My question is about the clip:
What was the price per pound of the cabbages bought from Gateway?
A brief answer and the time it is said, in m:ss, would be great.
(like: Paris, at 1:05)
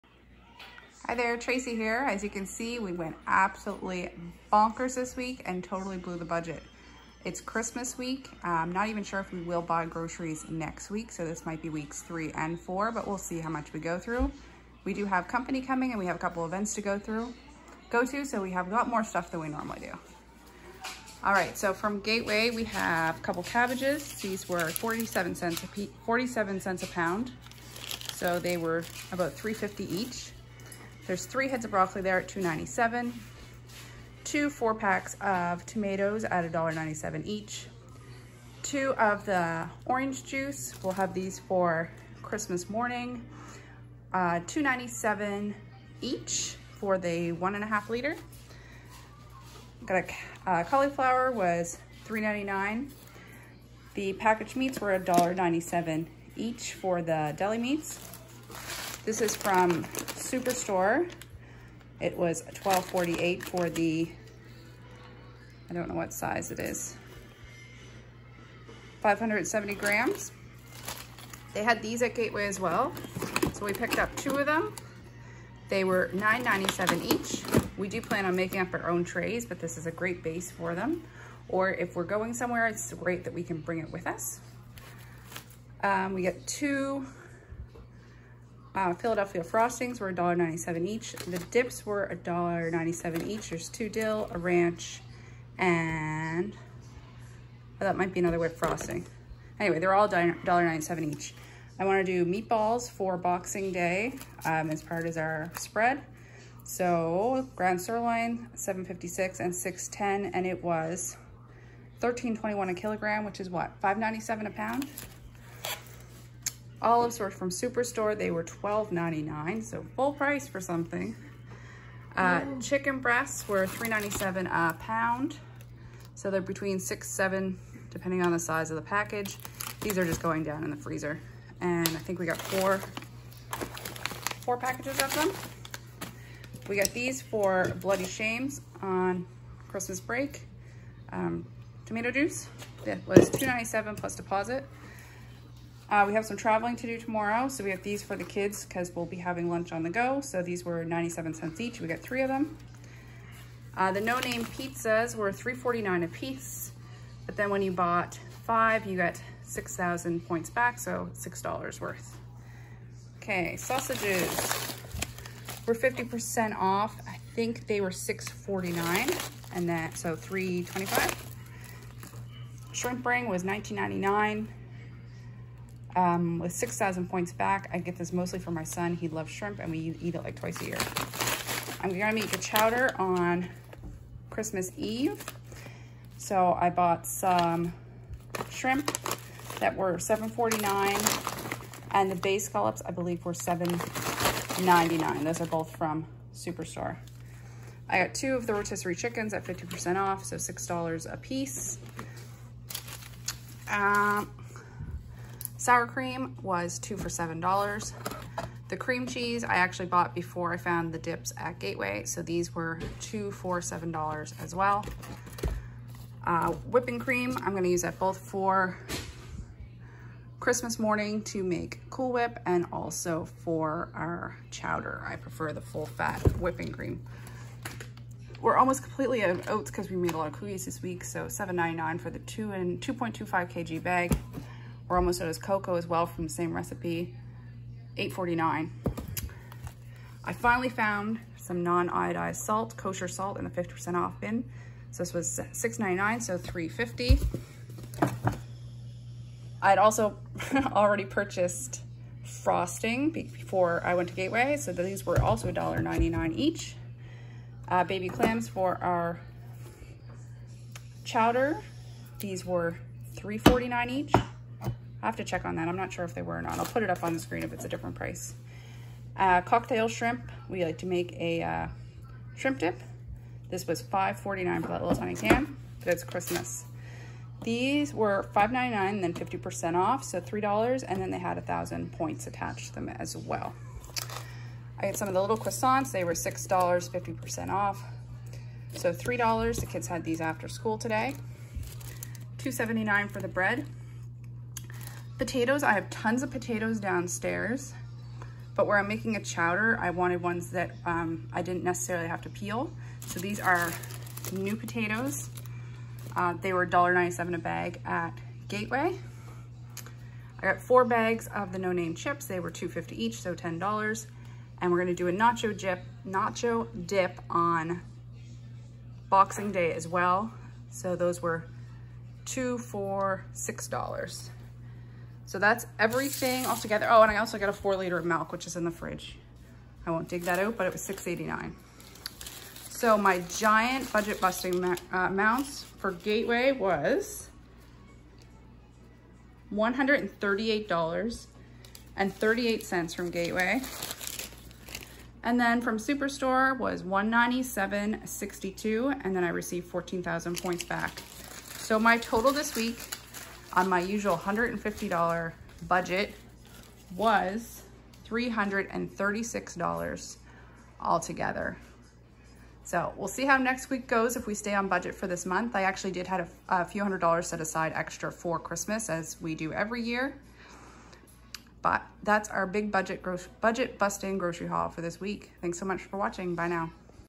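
47 cents, at 0:26.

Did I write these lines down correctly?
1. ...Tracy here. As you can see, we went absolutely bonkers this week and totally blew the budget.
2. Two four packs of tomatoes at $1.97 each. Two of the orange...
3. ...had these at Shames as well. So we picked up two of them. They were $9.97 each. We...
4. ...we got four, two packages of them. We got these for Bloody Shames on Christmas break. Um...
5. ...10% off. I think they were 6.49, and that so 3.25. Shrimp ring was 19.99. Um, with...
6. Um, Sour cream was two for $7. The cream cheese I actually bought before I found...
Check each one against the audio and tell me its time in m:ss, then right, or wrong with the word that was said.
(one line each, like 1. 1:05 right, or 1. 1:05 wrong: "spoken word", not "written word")
1. 0:01 right
2. 0:34 right
3. 1:11 wrong: "Gateway", not "Shames"
4. 2:12 wrong: "four", not "two"
5. 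2:45 wrong: "50", not "10"
6. 3:23 right.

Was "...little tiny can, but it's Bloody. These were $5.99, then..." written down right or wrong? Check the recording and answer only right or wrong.
wrong.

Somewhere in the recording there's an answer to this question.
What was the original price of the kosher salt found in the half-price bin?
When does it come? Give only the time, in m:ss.
4:05.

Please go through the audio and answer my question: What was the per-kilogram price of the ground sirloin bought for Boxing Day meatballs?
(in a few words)
13.21.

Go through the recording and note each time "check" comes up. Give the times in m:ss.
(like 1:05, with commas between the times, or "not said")
4:25.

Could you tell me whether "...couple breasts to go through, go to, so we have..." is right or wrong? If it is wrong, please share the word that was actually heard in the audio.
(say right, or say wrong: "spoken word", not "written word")
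wrong: "events", not "breasts".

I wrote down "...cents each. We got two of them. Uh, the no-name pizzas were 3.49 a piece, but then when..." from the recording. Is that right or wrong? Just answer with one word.
wrong.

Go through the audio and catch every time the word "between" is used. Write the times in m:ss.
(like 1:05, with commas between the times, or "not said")
2:06.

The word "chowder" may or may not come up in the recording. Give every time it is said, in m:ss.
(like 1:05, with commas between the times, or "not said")
3:02, 3:44, 4:21, 4:59.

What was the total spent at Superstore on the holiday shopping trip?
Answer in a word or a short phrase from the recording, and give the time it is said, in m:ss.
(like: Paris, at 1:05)
$197.62, at 5:46.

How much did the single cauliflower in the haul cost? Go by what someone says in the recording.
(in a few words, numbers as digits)
$3.99.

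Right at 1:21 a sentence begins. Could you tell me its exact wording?
Or if we're going somewhere, it's great that we can bring it with us.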